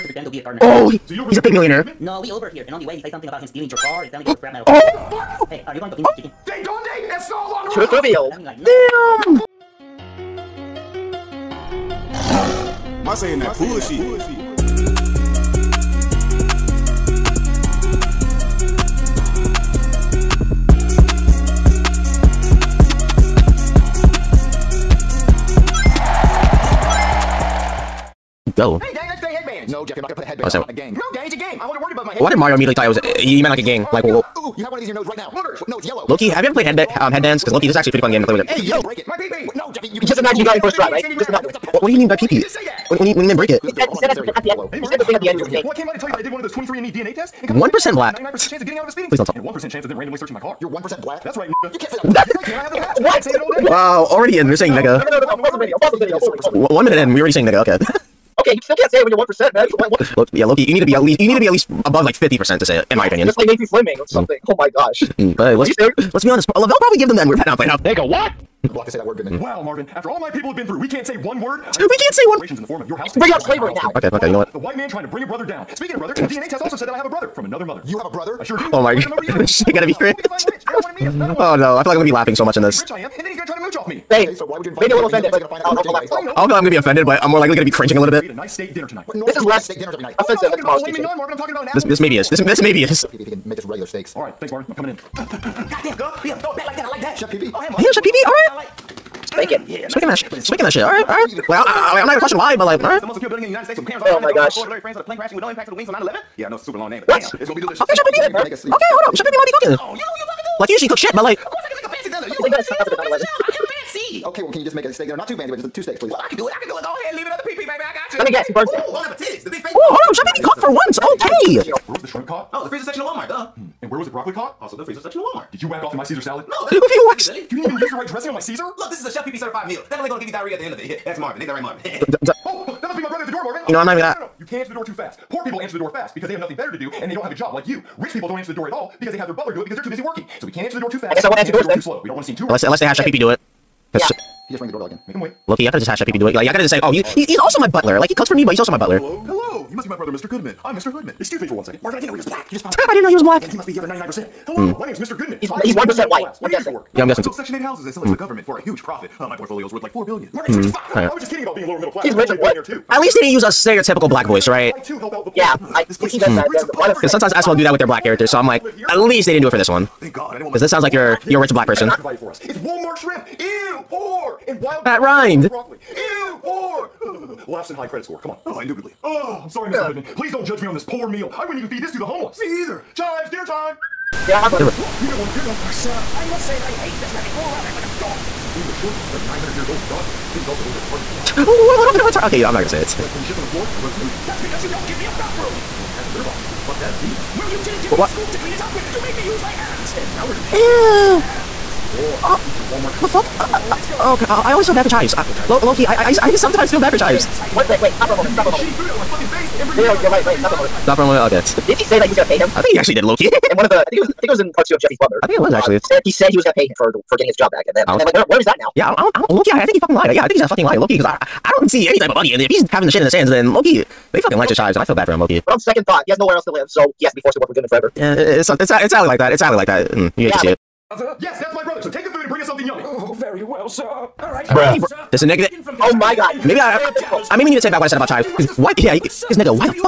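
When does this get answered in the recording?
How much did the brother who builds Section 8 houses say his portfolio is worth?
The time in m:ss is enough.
2:39.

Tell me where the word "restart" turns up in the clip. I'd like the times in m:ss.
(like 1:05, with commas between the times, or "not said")
not said.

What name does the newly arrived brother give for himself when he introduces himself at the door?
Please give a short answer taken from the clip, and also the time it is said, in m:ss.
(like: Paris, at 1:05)
Mr. Hoodman, at 2:30.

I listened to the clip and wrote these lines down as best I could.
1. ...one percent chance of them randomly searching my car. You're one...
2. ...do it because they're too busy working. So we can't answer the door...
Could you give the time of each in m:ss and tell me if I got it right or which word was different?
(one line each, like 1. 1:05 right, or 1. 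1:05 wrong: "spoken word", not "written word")
1. 0:49 right
2. 2:19 right.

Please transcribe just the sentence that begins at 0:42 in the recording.
When, when he when he meant break it.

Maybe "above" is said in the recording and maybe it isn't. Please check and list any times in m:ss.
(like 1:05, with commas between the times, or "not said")
0:31, 1:01.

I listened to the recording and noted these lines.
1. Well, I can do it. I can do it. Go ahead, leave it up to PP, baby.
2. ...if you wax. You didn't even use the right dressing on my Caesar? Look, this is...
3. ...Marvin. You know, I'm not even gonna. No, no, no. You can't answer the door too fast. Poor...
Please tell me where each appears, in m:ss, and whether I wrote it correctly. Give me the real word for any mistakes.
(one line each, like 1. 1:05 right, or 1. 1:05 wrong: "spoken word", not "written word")
1. 1:56 right
2. 2:06 right
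3. 2:13 right.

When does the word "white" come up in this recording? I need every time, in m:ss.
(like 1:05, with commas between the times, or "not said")
1:14, 2:36.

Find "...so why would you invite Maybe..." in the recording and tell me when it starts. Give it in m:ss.
1:24.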